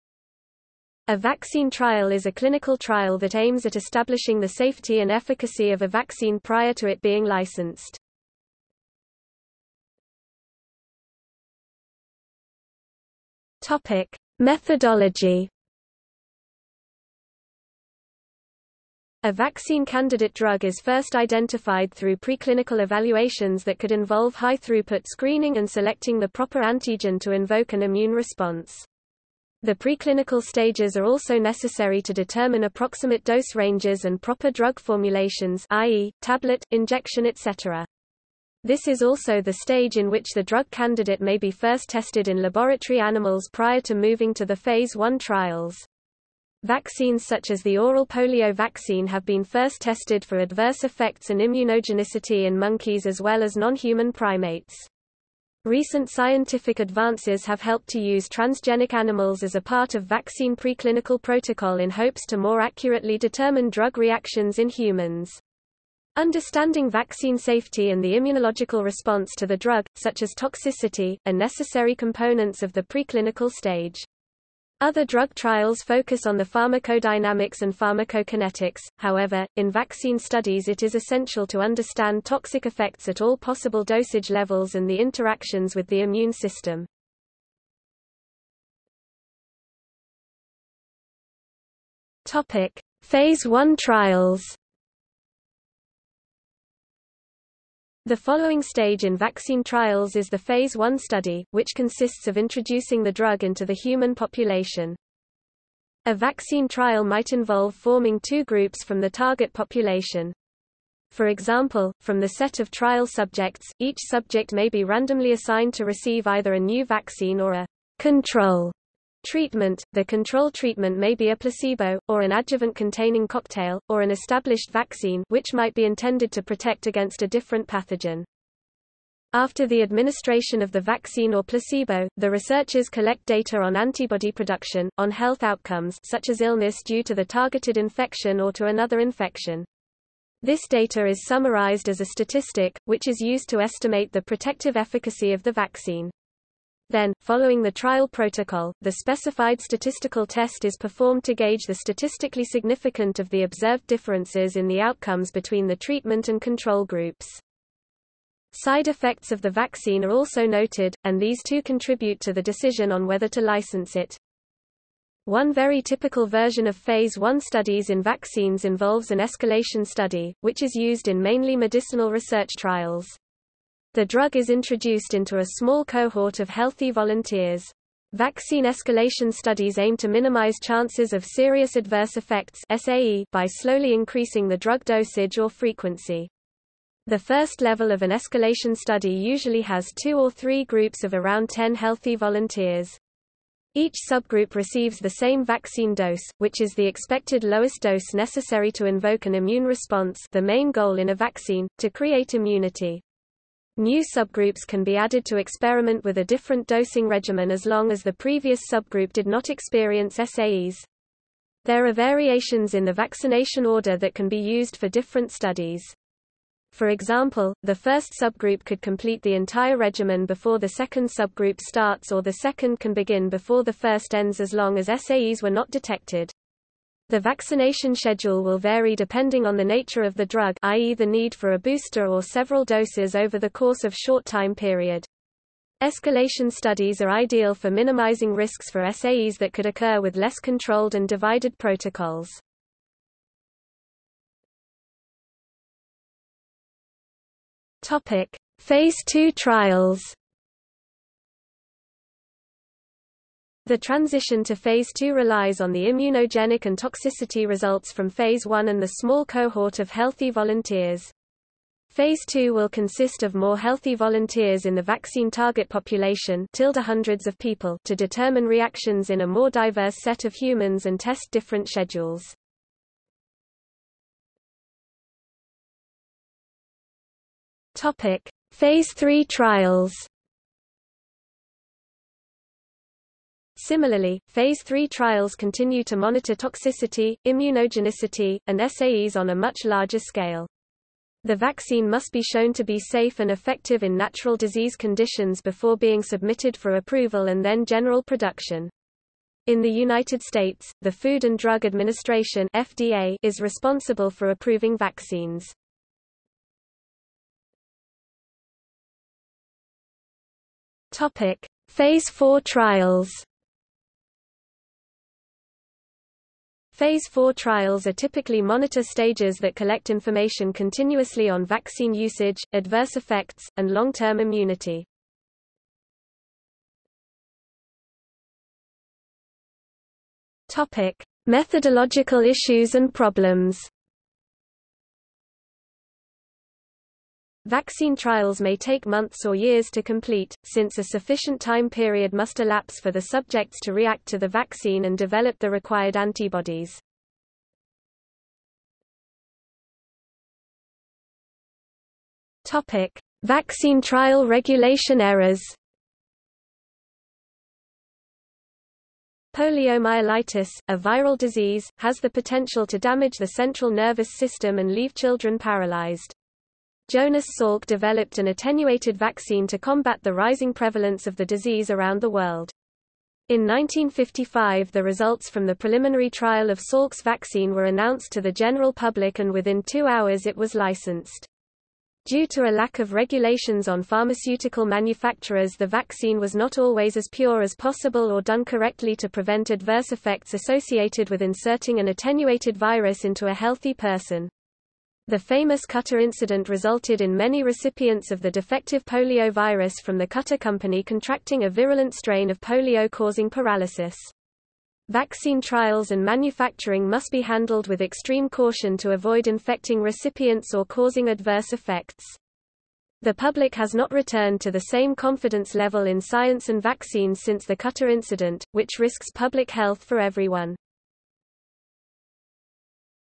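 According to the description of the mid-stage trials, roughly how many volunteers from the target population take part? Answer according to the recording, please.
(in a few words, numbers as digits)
hundreds.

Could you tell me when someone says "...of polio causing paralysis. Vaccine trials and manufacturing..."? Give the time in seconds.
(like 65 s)
402 s.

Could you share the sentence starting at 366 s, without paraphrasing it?
Jonas Salk developed an attenuated vaccine to combat the rising prevalence of the disease around the world.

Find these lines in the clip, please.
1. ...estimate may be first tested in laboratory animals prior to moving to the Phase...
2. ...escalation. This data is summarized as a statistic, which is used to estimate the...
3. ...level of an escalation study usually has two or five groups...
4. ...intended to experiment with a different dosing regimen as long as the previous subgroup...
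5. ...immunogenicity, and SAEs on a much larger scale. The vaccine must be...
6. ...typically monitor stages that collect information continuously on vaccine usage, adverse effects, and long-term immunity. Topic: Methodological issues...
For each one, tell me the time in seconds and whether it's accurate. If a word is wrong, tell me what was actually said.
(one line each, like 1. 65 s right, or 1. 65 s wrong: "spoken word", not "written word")
1. 40 s wrong: "candidate", not "estimate"
2. 138 s wrong: "infection", not "escalation"
3. 187 s wrong: "three", not "five"
4. 204 s wrong: "added", not "intended"
5. 287 s right
6. 317 s right.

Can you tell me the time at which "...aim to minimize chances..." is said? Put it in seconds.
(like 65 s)
179 s.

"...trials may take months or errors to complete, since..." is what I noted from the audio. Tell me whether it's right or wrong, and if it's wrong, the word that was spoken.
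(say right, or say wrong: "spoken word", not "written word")
wrong: "years", not "errors".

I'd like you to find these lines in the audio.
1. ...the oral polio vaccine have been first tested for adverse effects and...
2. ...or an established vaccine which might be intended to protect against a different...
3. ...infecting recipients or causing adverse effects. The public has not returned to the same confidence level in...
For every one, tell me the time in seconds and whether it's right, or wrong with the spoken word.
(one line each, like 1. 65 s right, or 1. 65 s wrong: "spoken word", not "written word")
1. 47 s right
2. 123 s right
3. 409 s right.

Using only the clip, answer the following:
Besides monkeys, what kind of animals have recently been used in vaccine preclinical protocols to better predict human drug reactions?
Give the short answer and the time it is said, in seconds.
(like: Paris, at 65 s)
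transgenic animals, at 58 s.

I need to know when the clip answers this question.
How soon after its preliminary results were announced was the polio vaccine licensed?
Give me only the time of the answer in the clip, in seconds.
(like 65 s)
379 s.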